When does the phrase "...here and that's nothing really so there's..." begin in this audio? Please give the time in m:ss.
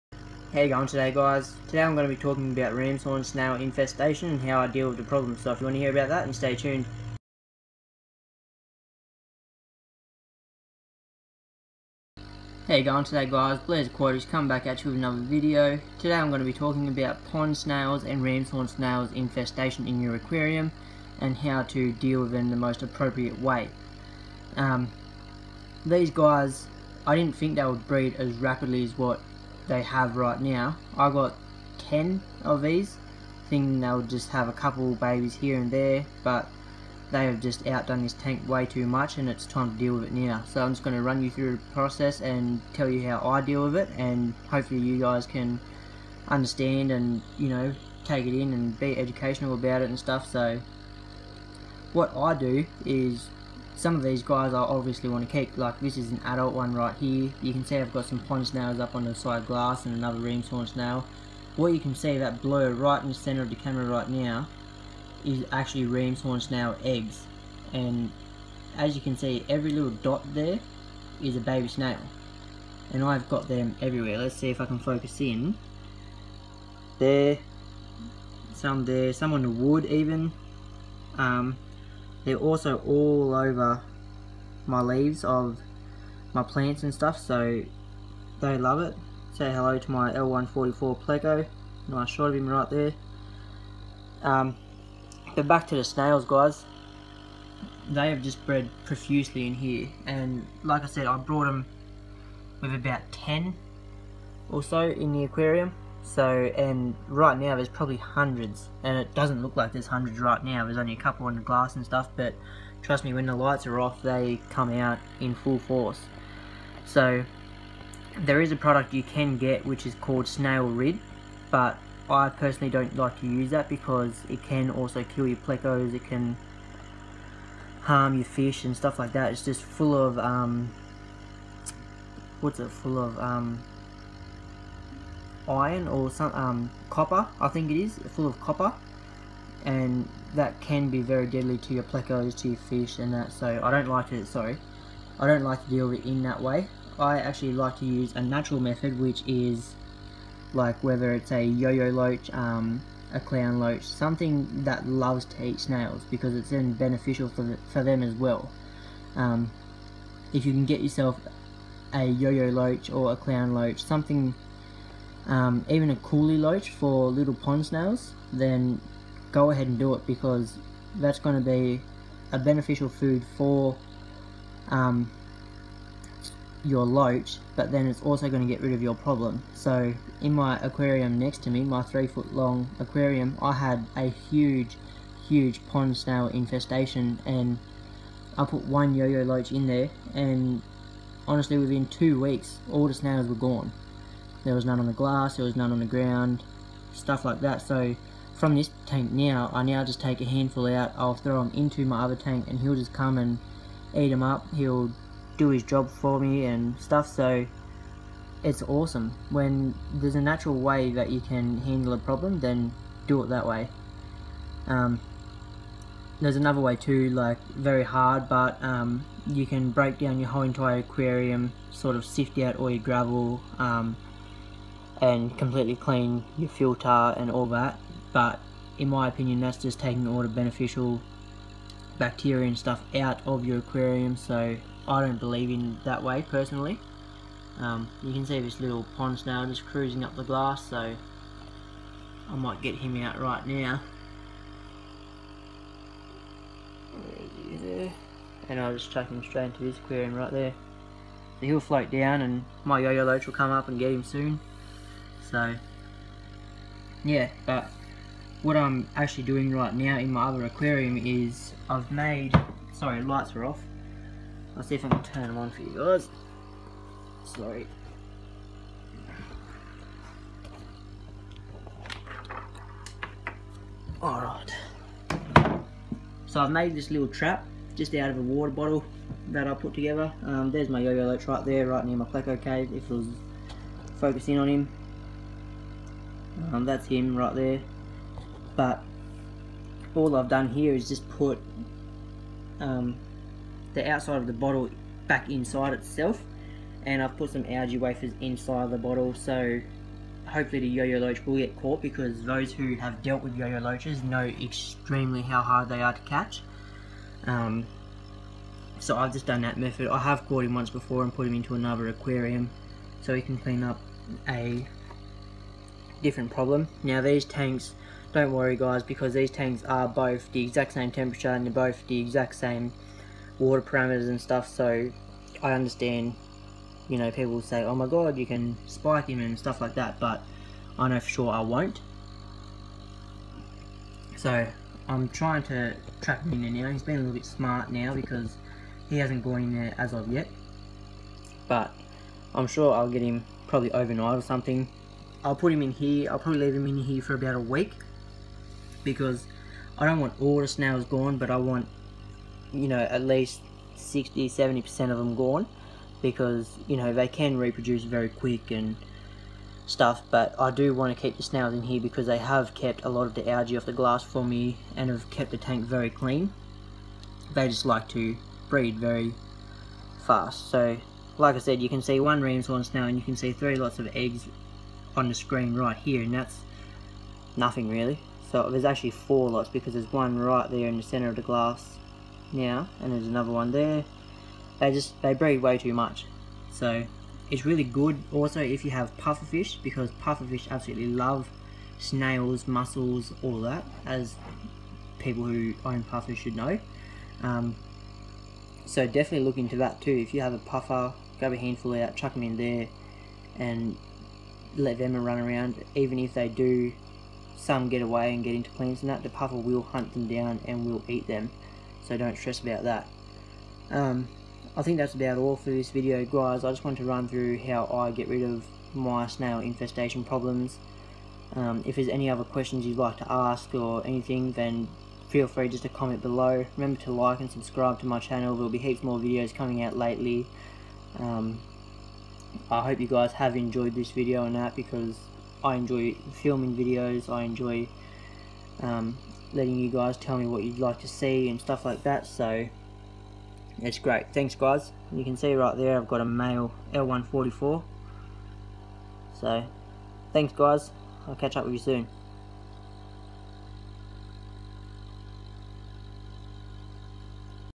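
6:15.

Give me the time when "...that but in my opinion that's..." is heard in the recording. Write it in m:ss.
3:47.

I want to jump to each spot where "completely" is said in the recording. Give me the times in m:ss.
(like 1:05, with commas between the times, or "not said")
3:45.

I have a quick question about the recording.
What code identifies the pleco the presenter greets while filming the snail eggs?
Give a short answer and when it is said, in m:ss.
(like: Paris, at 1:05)
L144, at 1:30.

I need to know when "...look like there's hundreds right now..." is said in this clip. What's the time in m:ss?
1:49.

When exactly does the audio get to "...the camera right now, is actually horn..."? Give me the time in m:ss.
1:03.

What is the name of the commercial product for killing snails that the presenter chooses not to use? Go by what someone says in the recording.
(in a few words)
Snail Rid.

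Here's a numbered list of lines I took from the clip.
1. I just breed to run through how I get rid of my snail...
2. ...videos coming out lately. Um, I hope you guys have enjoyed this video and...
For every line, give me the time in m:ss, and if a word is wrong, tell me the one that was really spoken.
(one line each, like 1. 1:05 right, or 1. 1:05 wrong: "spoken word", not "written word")
1. 6:56 wrong: "wanted", not "breed"
2. 7:08 right.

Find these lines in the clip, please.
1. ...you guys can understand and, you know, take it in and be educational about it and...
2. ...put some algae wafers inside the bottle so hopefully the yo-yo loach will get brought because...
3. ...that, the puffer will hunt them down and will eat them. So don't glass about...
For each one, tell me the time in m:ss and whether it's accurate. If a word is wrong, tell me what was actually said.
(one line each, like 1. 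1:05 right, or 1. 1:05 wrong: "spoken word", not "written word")
1. 0:44 right
2. 4:57 wrong: "caught", not "brought"
3. 6:48 wrong: "stress", not "glass".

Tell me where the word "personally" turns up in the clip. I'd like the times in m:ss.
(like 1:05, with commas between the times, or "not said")
2:02, 3:56.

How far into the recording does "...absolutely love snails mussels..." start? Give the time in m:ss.
6:30.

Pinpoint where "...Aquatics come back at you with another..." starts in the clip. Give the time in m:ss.
0:13.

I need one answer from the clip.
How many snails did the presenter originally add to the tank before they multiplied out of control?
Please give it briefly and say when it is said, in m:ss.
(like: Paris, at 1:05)
10, at 0:30.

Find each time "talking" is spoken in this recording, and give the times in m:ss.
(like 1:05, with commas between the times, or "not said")
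0:02, 0:16.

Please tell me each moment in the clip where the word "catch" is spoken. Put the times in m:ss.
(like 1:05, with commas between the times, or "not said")
5:06, 7:31.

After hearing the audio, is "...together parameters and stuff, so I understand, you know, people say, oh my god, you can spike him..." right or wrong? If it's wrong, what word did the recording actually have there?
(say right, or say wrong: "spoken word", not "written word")
wrong: "water", not "together".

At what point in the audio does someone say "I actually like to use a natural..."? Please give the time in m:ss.
2:26.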